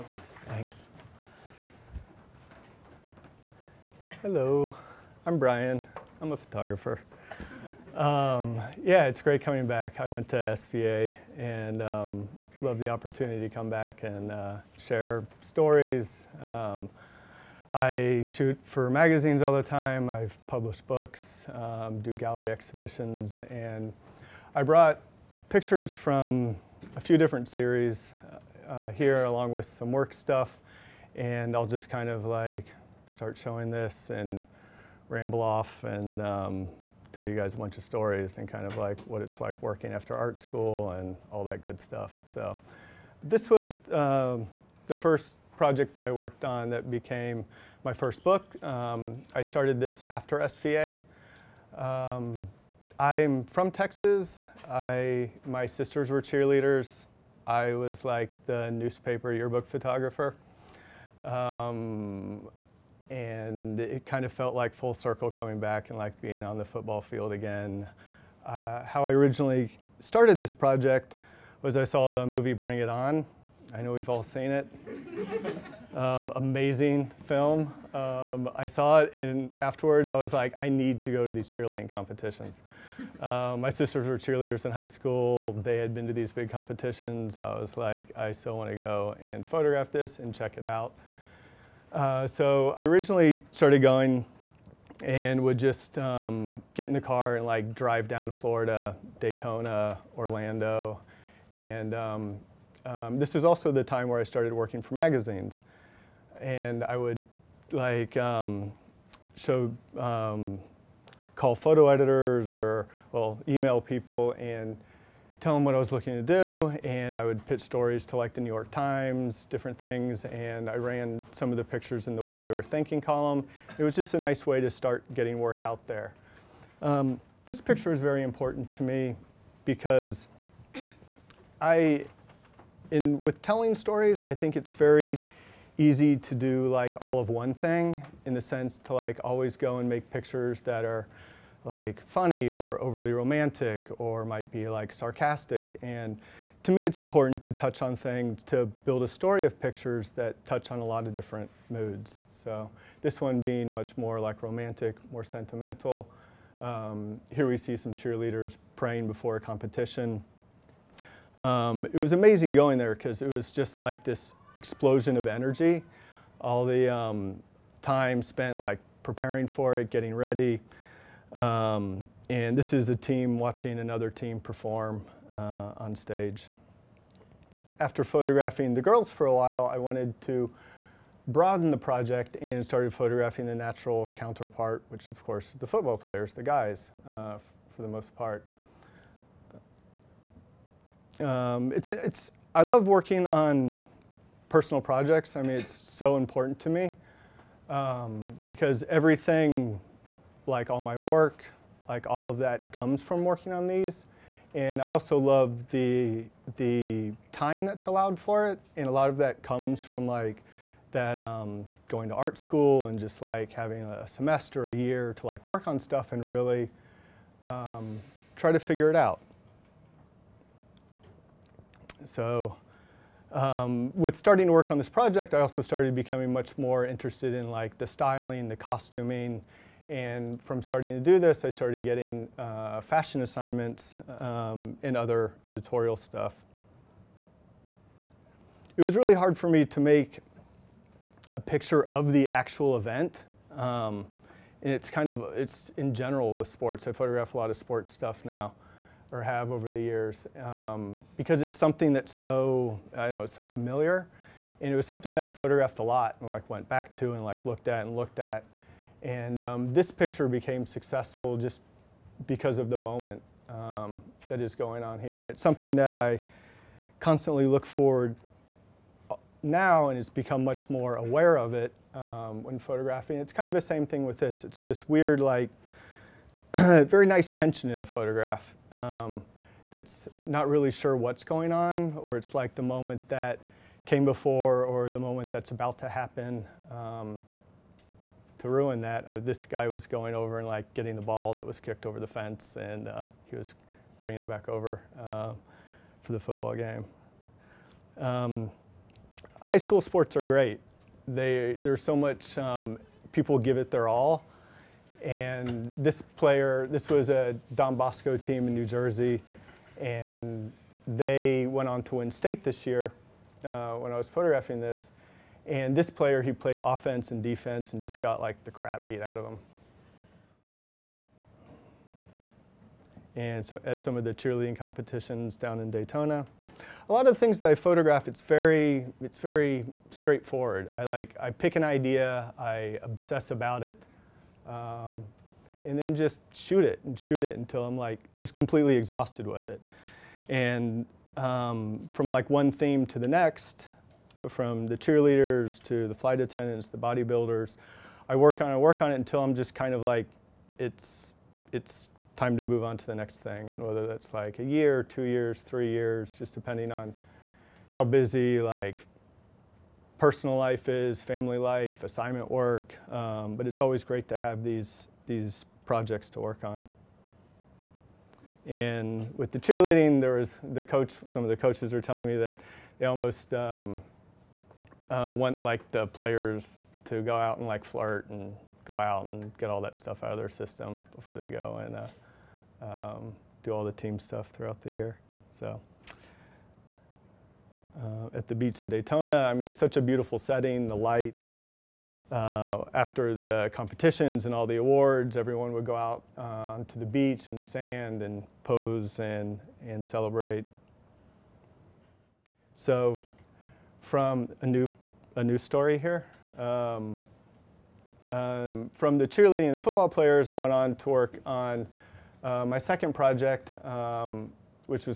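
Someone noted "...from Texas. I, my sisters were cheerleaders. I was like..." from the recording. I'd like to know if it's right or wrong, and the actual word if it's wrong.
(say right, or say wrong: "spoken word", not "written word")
right.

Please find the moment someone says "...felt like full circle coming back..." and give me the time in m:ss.
1:04.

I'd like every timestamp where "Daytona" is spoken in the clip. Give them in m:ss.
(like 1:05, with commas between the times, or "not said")
1:39, 5:25, 6:28.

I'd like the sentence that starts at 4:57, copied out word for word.
Um, high school sports are great.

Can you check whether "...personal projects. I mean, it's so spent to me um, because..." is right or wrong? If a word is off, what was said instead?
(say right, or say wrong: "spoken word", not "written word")
wrong: "important", not "spent".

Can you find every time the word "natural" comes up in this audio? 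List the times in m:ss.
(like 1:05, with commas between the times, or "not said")
3:03.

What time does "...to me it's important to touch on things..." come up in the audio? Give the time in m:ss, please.
2:26.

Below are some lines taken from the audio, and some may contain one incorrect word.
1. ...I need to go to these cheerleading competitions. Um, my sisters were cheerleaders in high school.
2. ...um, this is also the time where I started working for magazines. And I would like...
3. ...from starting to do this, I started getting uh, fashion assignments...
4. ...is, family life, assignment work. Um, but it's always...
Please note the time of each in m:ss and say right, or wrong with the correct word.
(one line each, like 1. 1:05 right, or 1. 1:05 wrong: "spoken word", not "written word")
1. 1:20 right
2. 1:42 right
3. 3:50 right
4. 6:00 right.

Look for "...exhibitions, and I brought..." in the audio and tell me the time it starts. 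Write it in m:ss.
0:22.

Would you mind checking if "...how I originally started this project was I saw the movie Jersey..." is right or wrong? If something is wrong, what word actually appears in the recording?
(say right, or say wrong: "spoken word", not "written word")
wrong: "Bring", not "Jersey".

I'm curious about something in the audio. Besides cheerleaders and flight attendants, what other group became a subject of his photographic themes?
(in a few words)
bodybuilders.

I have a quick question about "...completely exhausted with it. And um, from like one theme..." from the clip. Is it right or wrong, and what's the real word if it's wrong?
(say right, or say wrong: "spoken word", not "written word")
right.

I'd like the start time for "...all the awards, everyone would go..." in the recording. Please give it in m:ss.
6:34.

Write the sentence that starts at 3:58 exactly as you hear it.
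It was really hard for me to make a picture of the actual event.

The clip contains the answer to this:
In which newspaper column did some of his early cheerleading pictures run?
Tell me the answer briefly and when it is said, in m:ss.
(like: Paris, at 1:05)
What They Were Thinking, at 2:02.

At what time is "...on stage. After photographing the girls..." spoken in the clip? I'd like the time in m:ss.
2:55.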